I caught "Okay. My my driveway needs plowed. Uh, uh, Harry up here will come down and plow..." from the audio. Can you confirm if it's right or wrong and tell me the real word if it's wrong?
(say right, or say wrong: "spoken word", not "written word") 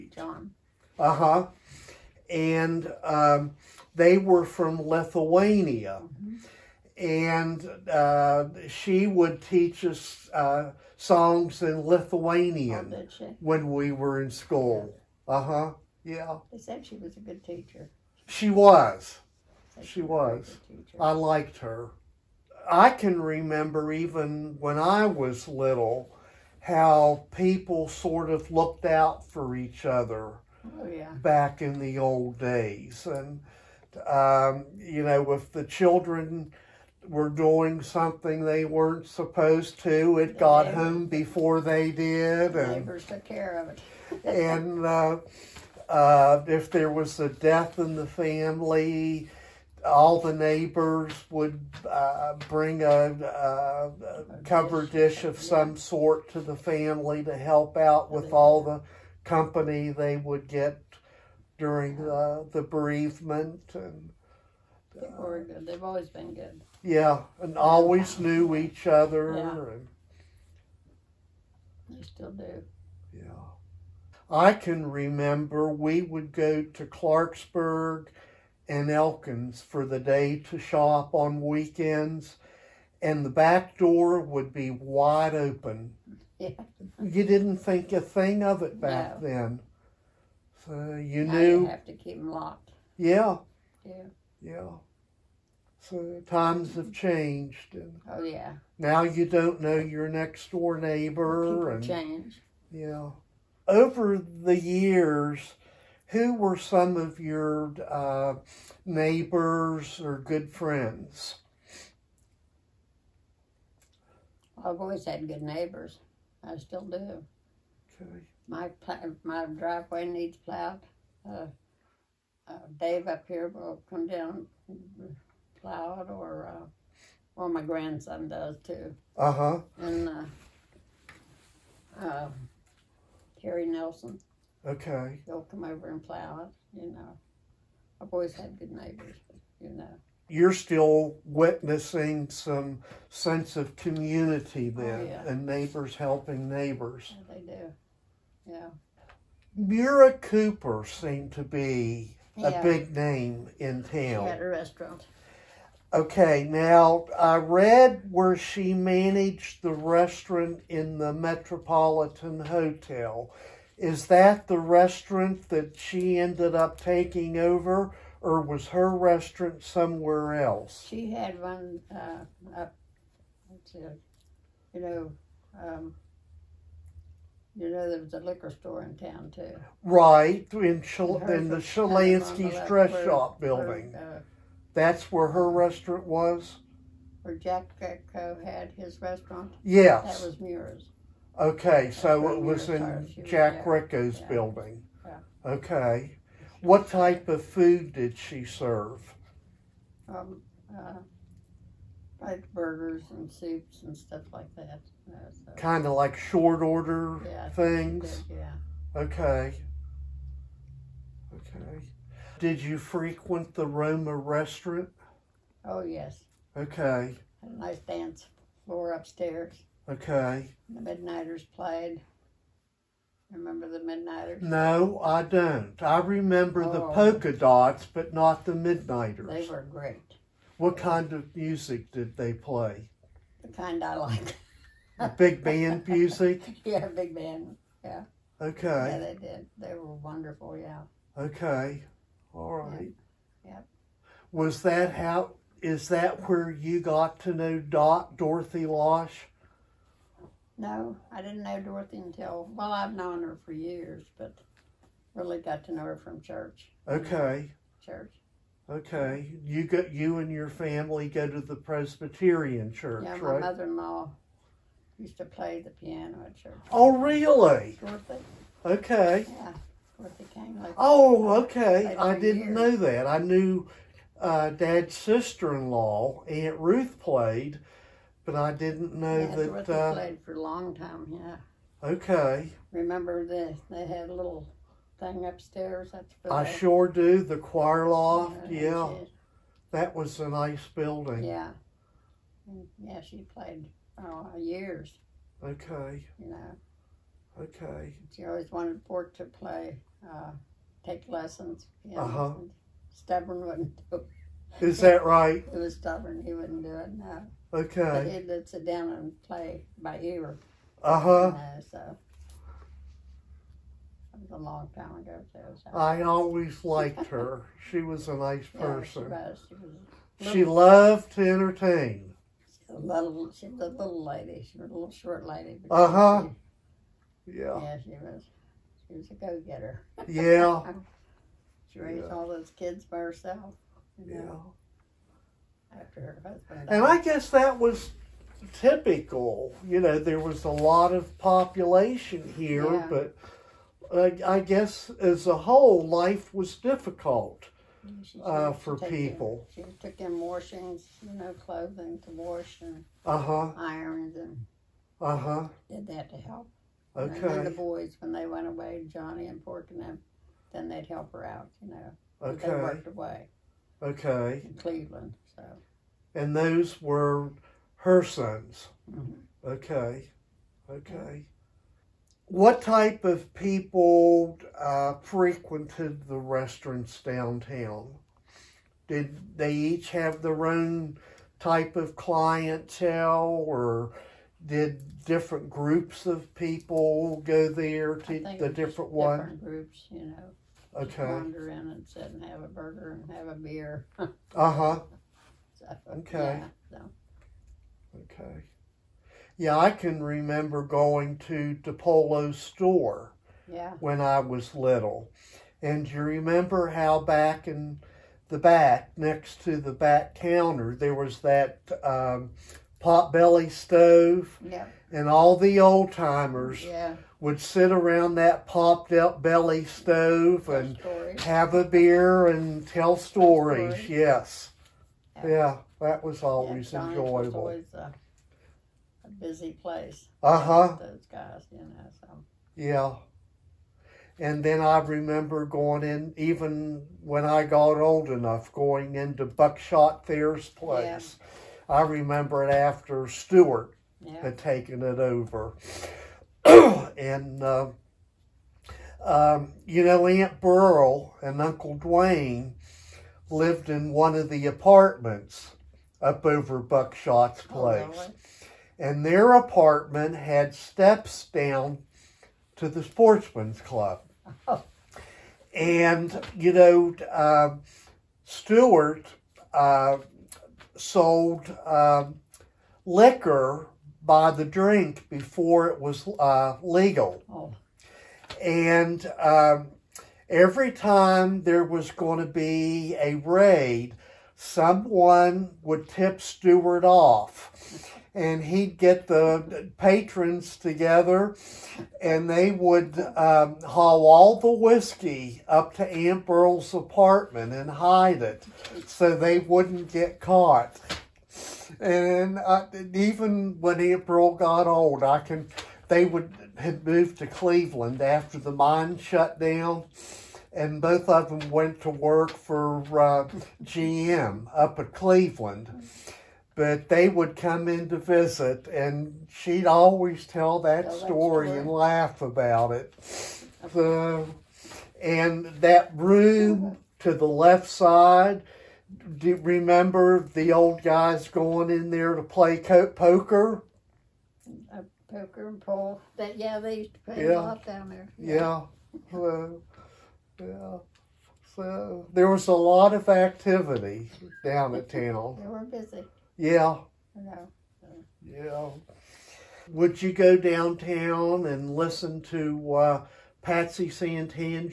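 wrong: "Dave", not "Harry".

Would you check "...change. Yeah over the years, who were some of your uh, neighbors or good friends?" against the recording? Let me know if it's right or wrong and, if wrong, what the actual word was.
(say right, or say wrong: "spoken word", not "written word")
right.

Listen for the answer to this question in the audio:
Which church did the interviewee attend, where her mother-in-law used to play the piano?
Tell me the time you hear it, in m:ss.
4:21.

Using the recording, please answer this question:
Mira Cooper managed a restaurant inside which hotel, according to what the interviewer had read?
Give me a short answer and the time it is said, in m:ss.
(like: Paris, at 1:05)
Metropolitan Hotel, at 2:41.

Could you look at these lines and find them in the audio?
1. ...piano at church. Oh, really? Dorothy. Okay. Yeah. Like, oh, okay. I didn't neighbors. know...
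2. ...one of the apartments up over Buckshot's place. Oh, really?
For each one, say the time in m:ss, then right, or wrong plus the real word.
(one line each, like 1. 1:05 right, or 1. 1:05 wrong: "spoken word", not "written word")
1. 4:25 wrong: "years", not "neighbors"
2. 7:33 right.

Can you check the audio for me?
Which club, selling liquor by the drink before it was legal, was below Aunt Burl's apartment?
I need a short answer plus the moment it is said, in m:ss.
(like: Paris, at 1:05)
Sportsman's Club, at 7:42.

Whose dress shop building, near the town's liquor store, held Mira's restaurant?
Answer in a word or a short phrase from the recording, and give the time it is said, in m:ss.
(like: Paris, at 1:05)
Shalansky's, at 3:01.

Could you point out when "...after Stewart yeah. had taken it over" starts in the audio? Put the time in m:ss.
7:22.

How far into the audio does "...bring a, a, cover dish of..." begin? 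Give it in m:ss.
0:52.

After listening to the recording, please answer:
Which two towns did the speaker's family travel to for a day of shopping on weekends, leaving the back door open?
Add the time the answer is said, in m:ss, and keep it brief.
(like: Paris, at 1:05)
Clarksburg and Elkins, at 1:16.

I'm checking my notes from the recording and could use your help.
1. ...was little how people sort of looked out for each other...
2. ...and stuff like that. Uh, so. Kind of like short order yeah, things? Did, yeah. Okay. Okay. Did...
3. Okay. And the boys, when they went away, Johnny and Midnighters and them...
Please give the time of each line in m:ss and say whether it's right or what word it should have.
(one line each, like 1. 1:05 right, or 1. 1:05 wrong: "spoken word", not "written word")
1. 0:25 right
2. 3:23 right
3. 5:56 wrong: "Pork", not "Midnighters".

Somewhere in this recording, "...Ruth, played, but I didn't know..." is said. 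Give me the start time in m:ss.
4:36.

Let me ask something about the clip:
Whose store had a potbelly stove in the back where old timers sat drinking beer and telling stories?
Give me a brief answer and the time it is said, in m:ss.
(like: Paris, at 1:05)
DePolo's, at 6:41.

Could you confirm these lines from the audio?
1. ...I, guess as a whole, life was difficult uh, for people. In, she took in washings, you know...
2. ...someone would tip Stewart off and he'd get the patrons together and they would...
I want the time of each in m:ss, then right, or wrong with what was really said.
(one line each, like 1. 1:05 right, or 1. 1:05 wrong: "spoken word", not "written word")
1. 5:44 right
2. 8:04 right.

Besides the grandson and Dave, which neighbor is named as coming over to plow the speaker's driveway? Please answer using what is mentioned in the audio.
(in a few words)
Harry Nelson.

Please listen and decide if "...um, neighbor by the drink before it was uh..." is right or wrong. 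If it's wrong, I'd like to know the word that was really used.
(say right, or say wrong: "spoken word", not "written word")
wrong: "liquor", not "neighbor".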